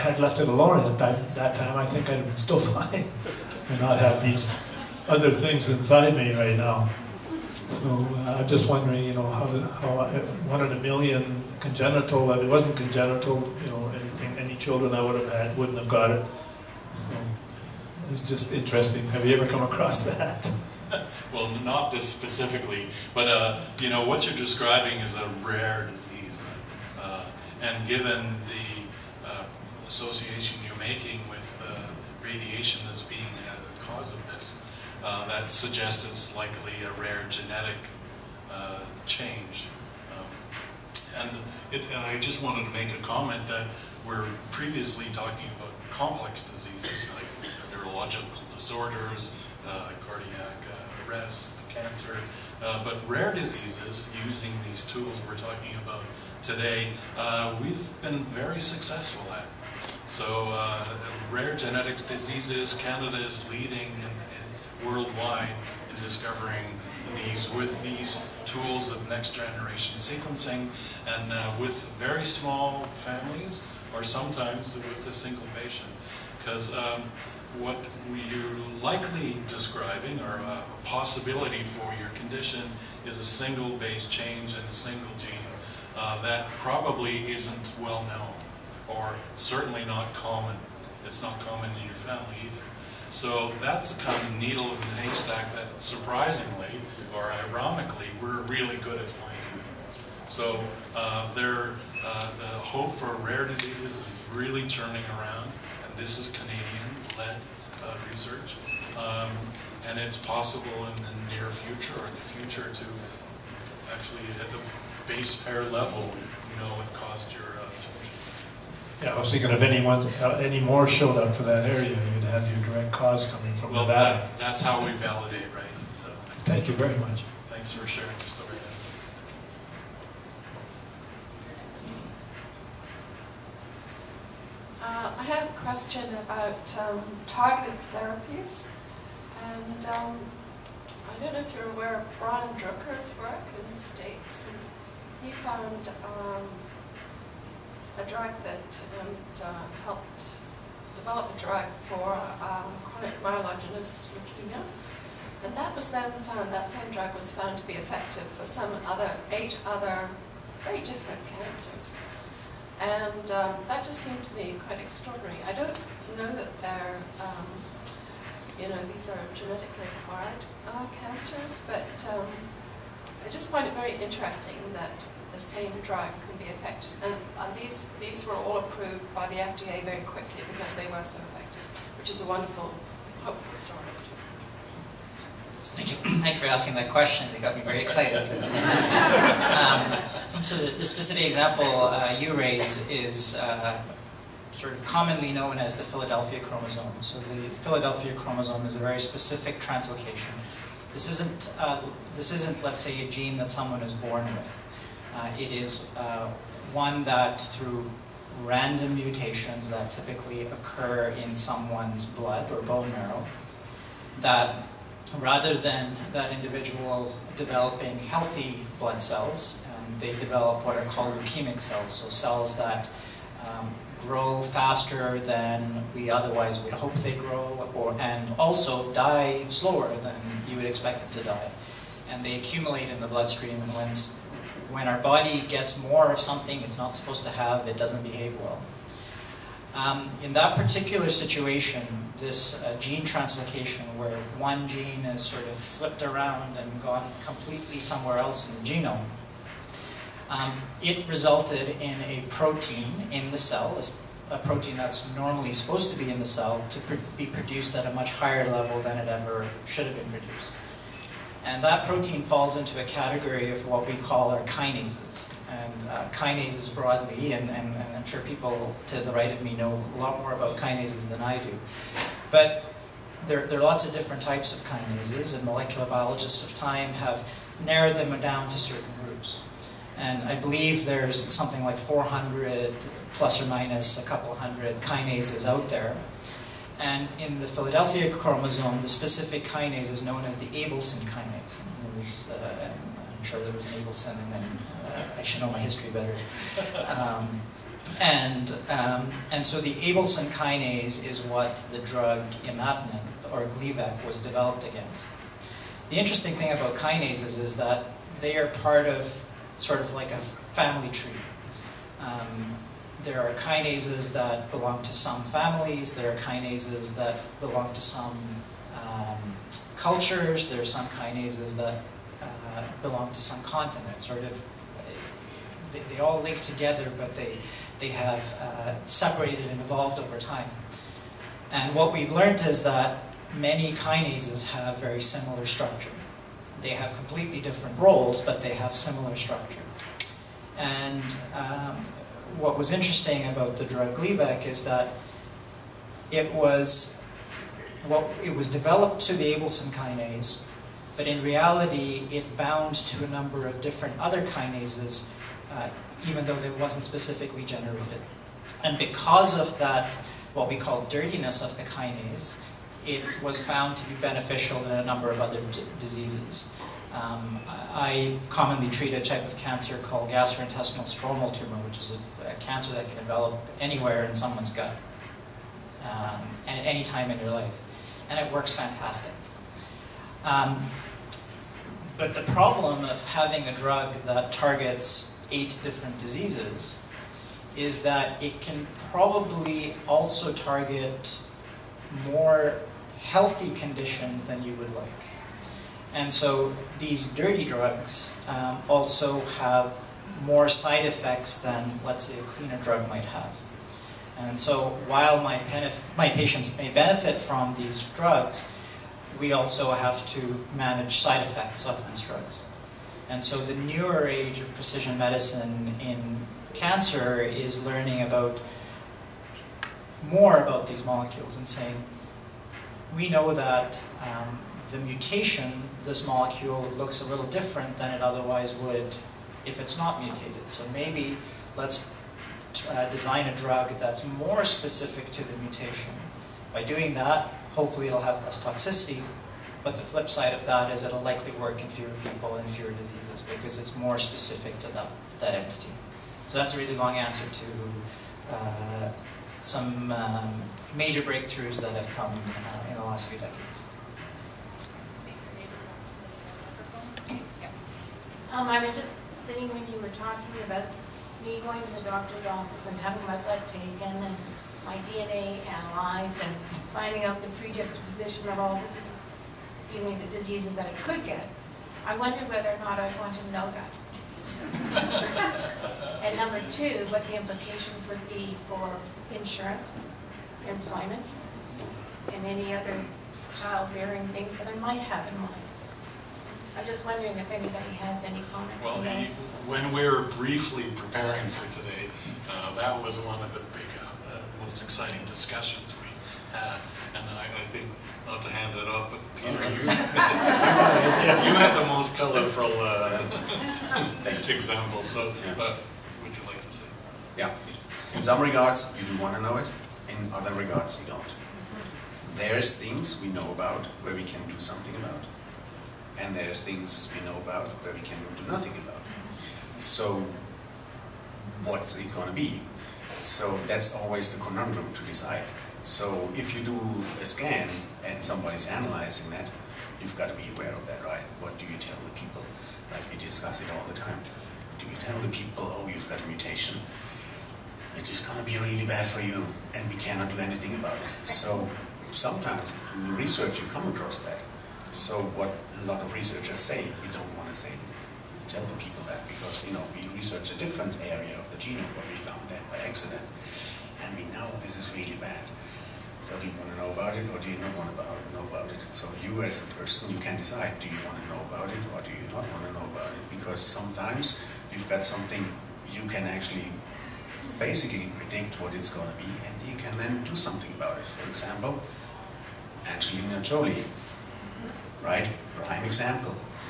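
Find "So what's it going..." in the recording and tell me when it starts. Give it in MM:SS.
08:39.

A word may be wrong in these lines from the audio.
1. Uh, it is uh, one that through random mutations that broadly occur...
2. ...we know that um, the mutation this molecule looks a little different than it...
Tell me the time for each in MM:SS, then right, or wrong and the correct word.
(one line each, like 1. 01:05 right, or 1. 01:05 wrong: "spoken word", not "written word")
1. 03:25 wrong: "typically", not "broadly"
2. 07:02 right.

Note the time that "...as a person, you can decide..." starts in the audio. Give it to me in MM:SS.
09:19.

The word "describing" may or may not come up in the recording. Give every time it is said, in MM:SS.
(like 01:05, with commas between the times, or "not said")
00:24, 01:19.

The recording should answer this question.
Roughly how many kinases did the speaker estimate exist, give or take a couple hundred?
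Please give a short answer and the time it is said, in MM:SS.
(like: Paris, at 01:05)
400, at 04:41.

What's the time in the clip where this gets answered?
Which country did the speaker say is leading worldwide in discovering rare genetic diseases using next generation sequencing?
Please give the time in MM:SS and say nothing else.
01:02.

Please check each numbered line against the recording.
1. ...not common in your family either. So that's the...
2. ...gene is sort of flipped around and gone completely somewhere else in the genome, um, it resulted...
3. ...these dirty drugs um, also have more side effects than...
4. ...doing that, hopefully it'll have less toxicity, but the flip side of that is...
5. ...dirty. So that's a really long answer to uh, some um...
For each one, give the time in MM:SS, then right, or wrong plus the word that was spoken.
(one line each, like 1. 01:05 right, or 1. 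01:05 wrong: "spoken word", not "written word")
1. 01:31 right
2. 04:04 right
3. 06:36 right
4. 07:16 right
5. 07:25 wrong: "entity", not "dirty".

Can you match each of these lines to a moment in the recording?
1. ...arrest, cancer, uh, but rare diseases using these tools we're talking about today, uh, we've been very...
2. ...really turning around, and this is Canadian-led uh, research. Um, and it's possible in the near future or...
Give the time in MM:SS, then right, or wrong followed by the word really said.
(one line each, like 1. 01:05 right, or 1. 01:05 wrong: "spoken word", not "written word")
1. 00:51 right
2. 01:44 right.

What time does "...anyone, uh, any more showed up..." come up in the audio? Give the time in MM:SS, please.
01:59.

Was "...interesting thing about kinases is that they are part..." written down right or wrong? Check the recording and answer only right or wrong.
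right.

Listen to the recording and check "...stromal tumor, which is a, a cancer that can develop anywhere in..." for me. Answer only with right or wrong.
right.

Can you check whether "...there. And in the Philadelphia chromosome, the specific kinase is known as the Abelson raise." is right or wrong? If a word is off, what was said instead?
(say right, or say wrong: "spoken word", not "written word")
wrong: "kinase", not "raise".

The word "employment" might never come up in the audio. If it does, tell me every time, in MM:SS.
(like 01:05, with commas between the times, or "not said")
08:00.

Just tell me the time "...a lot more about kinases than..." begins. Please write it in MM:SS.
04:29.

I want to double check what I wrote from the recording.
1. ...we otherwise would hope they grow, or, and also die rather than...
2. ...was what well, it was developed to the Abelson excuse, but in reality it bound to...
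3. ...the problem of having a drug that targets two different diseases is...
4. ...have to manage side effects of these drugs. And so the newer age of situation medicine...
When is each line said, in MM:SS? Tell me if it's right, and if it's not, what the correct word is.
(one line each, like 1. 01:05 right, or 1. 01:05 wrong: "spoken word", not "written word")
1. 03:45 wrong: "slower", not "rather"
2. 05:46 wrong: "kinase", not "excuse"
3. 06:22 wrong: "eight", not "two"
4. 06:49 wrong: "precision", not "situation".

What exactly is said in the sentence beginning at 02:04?
Well, that's how we validate, right?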